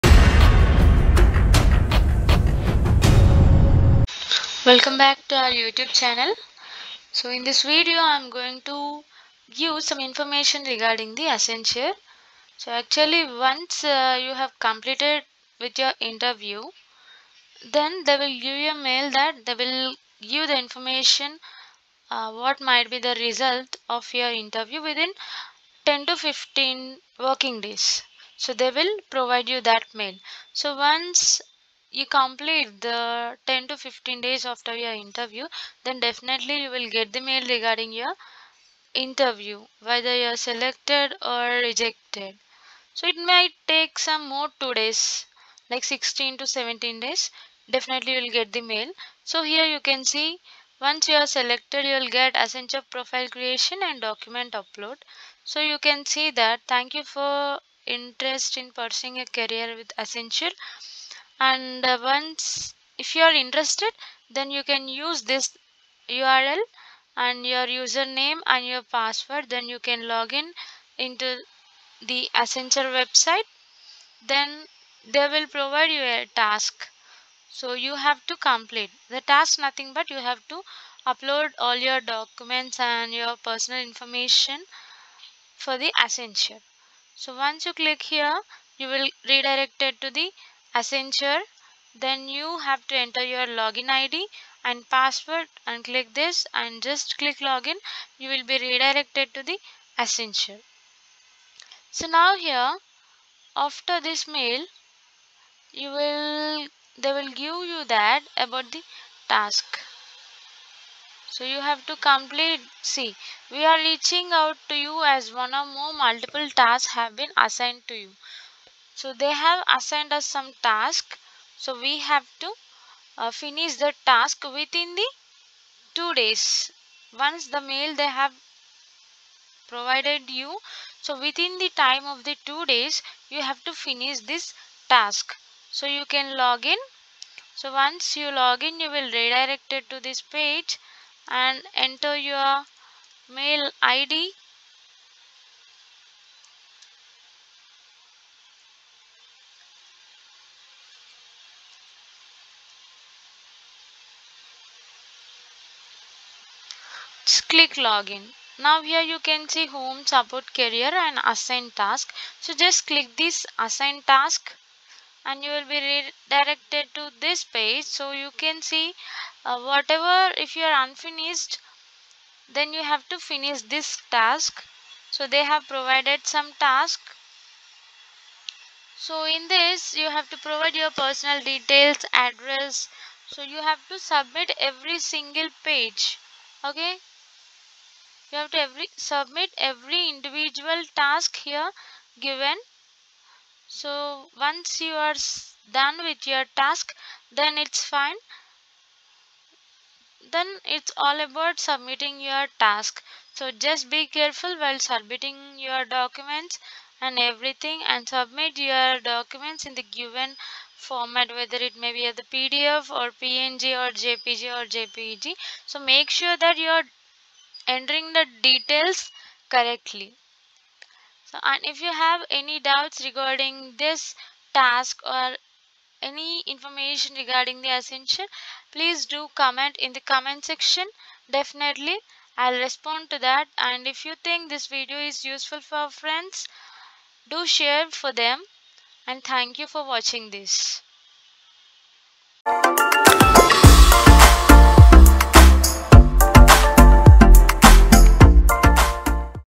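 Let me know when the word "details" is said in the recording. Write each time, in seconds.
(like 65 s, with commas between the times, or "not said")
181 s, 218 s.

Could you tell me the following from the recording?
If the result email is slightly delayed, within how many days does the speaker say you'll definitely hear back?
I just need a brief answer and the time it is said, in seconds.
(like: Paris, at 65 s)
16 to 17 days, at 45 s.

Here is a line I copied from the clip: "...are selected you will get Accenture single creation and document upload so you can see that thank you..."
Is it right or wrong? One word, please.
wrong.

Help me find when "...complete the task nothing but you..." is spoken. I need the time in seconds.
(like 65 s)
78 s.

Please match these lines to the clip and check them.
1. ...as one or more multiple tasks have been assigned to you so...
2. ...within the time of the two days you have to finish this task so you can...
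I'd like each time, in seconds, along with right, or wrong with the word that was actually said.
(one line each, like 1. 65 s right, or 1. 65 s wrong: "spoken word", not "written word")
1. 115 s right
2. 131 s right.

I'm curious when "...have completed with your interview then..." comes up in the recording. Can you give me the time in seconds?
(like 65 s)
14 s.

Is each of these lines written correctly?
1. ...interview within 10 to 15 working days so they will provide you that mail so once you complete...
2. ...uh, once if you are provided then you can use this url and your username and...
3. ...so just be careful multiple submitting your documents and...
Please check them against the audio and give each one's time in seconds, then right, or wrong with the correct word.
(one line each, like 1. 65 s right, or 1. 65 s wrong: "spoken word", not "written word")
1. 24 s right
2. 61 s wrong: "interested", not "provided"
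3. 203 s wrong: "while", not "multiple".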